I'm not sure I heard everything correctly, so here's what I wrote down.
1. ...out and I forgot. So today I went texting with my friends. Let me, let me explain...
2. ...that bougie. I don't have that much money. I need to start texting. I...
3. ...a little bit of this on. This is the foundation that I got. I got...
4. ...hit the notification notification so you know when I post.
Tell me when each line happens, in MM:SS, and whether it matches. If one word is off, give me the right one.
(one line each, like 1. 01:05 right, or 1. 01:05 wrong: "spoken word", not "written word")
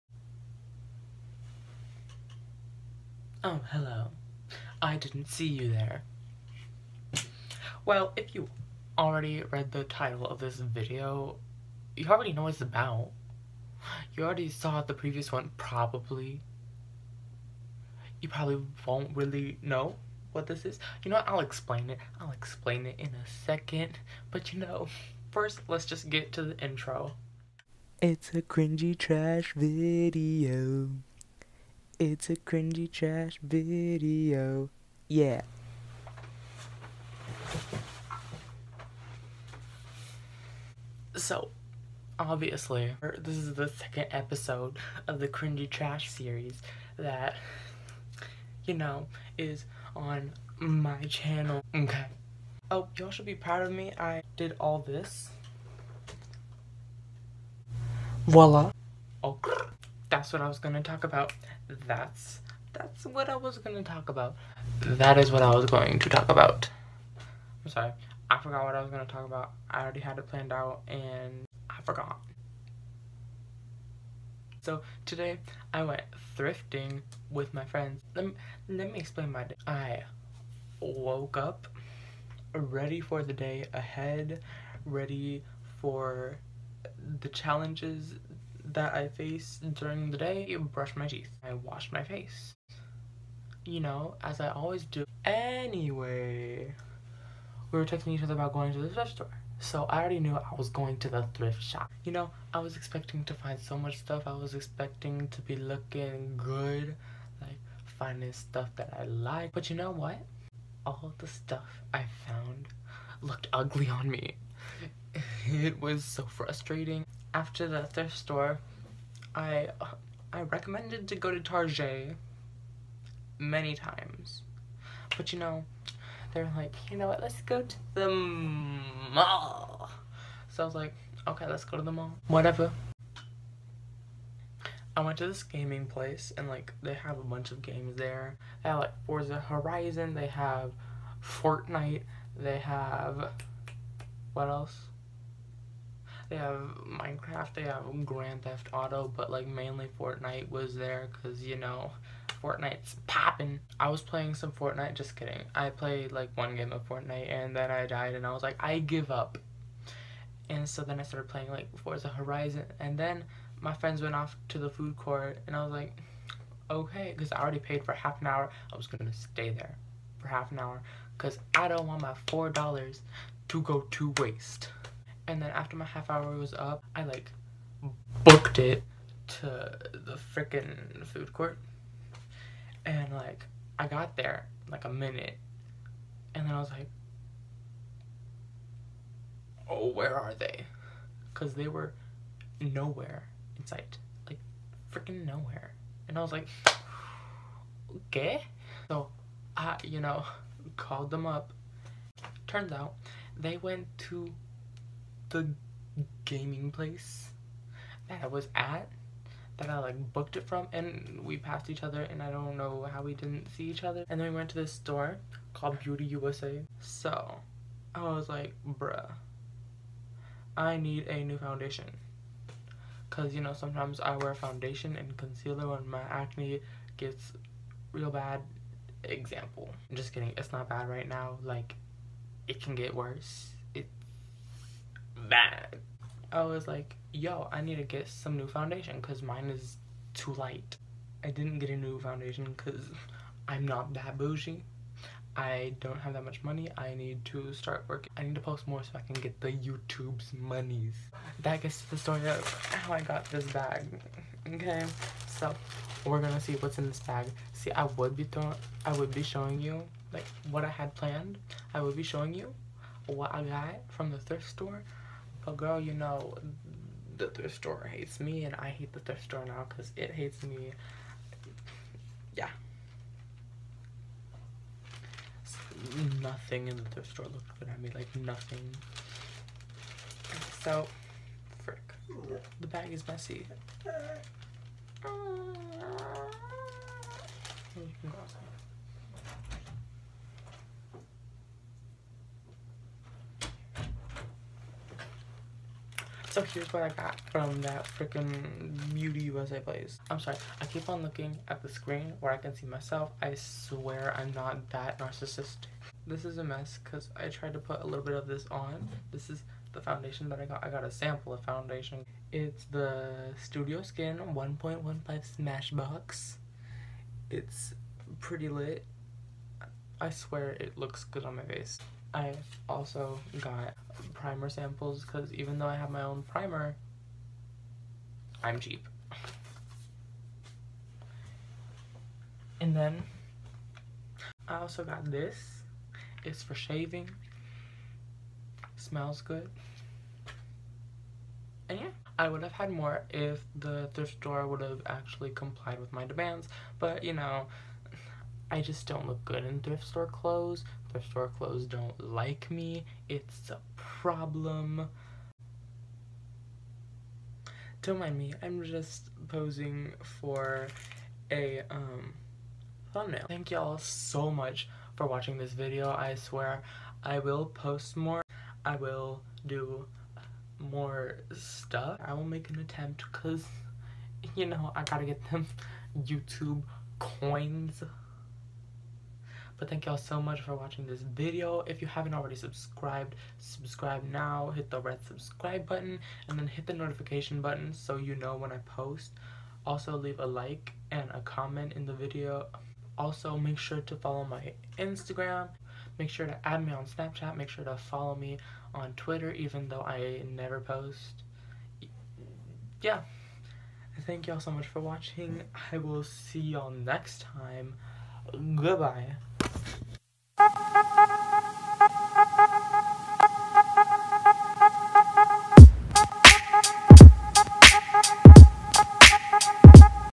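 1. 01:10 wrong: "thrifting", not "texting"
2. 04:03 wrong: "working", not "texting"
3. 05:07 right
4. 06:26 wrong: "button", not "notification".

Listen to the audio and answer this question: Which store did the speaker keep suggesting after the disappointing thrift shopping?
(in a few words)
Target.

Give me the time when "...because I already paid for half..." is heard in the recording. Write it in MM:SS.
02:47.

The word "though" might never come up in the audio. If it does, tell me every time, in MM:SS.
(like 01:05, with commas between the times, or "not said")
05:25, 06:39.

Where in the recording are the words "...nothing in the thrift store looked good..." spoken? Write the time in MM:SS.
04:36.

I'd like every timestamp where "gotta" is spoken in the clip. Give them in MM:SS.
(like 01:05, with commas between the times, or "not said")
06:14.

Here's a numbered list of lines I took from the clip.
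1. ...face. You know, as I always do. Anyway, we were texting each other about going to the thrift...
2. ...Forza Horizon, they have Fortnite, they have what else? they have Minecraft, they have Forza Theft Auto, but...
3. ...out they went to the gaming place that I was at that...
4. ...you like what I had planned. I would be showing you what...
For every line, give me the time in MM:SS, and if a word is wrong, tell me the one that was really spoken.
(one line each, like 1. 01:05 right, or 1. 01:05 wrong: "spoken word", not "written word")
1. 01:32 right
2. 02:19 wrong: "Grand", not "Forza"
3. 03:22 right
4. 04:19 right.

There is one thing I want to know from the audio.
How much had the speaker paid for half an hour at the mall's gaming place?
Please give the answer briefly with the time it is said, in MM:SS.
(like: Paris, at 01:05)
$4, at 02:52.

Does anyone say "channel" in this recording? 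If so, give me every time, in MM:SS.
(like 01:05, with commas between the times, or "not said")
00:51.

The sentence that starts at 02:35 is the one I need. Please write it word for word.
I played like one game of Fortnite and then I died and I was like, I give up.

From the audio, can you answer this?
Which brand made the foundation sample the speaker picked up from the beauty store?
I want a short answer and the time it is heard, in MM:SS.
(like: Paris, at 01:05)
Smashbox, at 05:15.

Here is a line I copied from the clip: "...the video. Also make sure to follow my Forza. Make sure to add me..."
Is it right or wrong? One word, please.
wrong.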